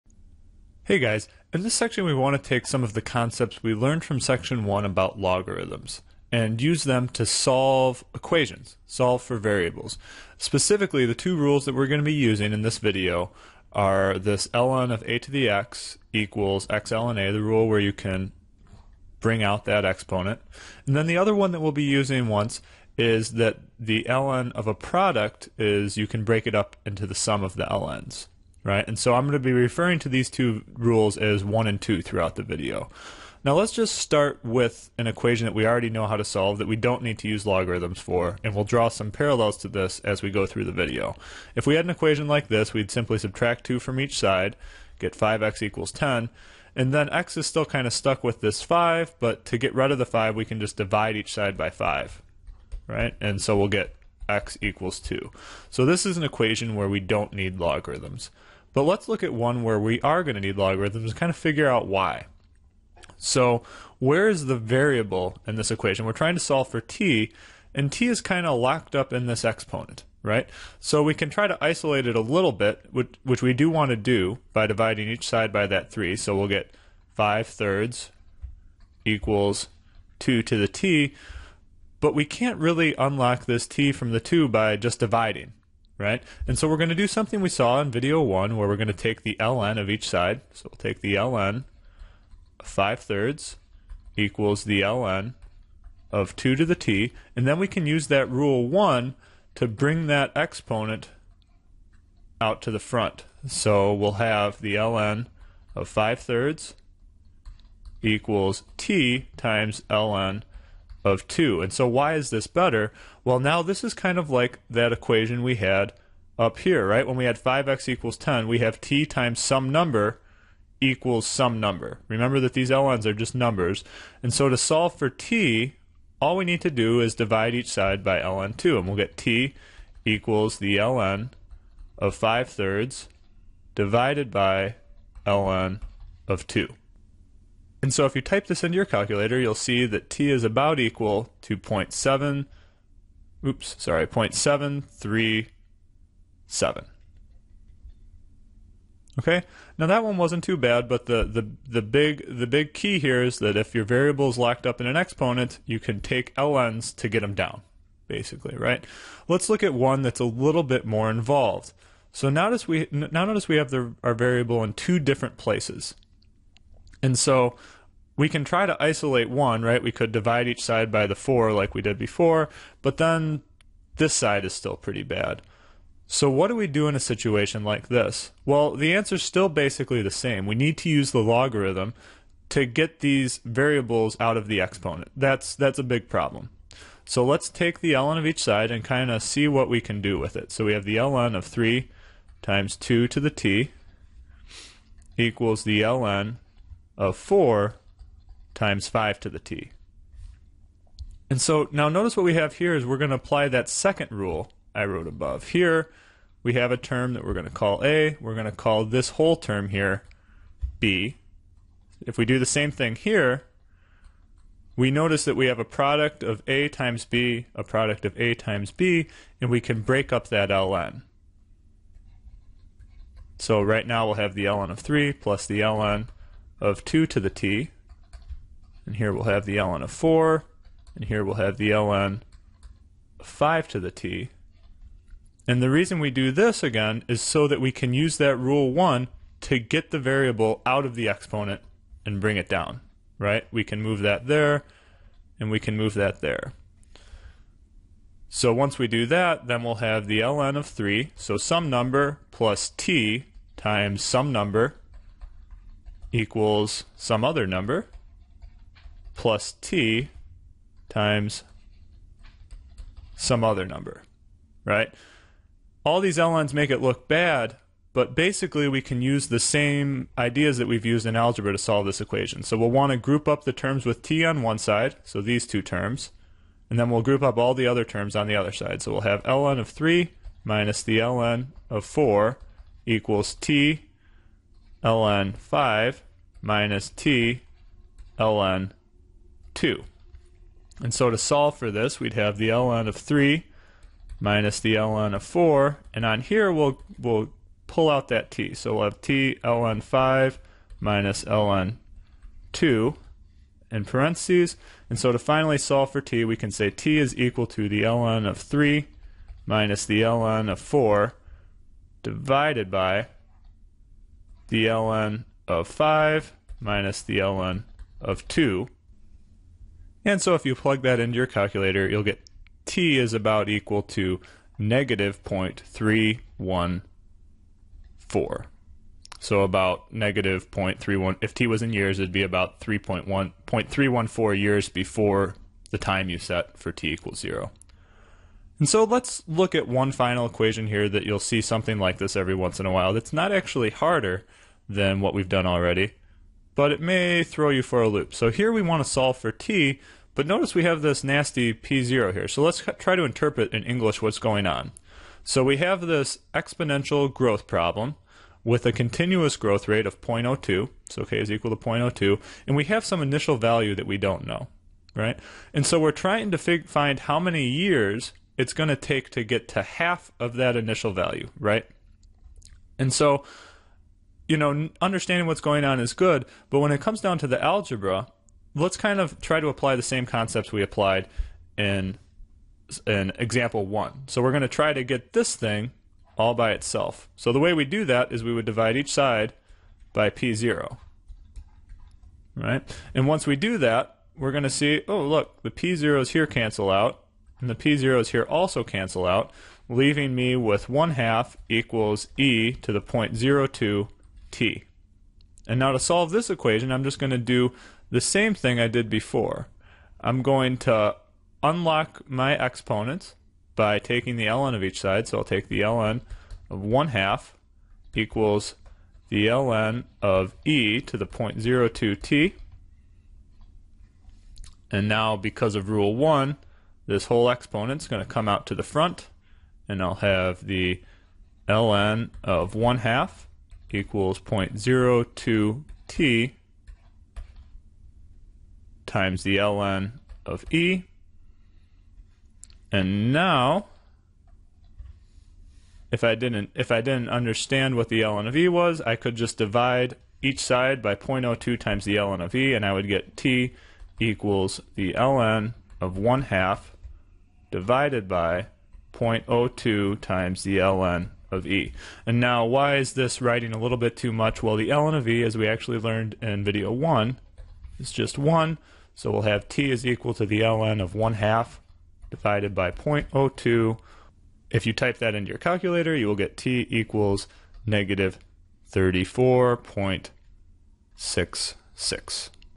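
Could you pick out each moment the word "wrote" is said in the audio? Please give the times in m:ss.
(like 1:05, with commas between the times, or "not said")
3:24.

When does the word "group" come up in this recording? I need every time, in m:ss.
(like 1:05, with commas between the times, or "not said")
4:32, 4:37.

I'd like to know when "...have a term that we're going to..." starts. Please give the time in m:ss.
3:26.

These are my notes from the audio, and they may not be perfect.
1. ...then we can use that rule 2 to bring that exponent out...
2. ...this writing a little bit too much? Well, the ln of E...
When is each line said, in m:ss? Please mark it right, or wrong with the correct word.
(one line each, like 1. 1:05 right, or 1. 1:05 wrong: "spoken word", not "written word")
1. 1:37 wrong: "1", not "2"
2. 7:42 right.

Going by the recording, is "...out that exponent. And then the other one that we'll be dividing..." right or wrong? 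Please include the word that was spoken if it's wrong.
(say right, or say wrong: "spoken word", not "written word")
wrong: "using", not "dividing".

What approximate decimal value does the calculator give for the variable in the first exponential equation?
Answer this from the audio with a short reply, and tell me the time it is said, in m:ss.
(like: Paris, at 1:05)
0.737, at 2:24.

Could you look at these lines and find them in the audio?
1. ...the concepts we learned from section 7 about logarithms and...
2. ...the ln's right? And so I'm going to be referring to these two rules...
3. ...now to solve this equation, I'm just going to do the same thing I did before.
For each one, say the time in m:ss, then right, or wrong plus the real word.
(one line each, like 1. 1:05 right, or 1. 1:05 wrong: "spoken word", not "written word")
1. 0:02 wrong: "1", not "7"
2. 0:27 right
3. 6:45 right.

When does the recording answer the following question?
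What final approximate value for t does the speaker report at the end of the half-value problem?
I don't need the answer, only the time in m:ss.
7:57.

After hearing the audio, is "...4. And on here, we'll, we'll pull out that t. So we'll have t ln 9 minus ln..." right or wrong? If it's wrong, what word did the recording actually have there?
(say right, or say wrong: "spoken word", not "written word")
wrong: "5", not "9".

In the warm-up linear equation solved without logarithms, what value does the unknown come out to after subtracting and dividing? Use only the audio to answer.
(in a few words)
x = 2.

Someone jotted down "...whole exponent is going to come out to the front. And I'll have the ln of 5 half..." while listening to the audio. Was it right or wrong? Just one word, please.
wrong.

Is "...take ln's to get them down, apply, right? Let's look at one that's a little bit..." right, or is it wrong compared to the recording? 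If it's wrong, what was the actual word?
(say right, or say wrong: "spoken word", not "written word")
wrong: "basically", not "apply".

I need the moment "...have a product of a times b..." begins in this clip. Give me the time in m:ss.
3:35.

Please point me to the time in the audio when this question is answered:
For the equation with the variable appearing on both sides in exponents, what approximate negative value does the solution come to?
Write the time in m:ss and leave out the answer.
5:24.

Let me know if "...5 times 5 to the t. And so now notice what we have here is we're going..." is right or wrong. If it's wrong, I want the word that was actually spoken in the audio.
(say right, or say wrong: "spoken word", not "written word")
wrong: "4", not "5".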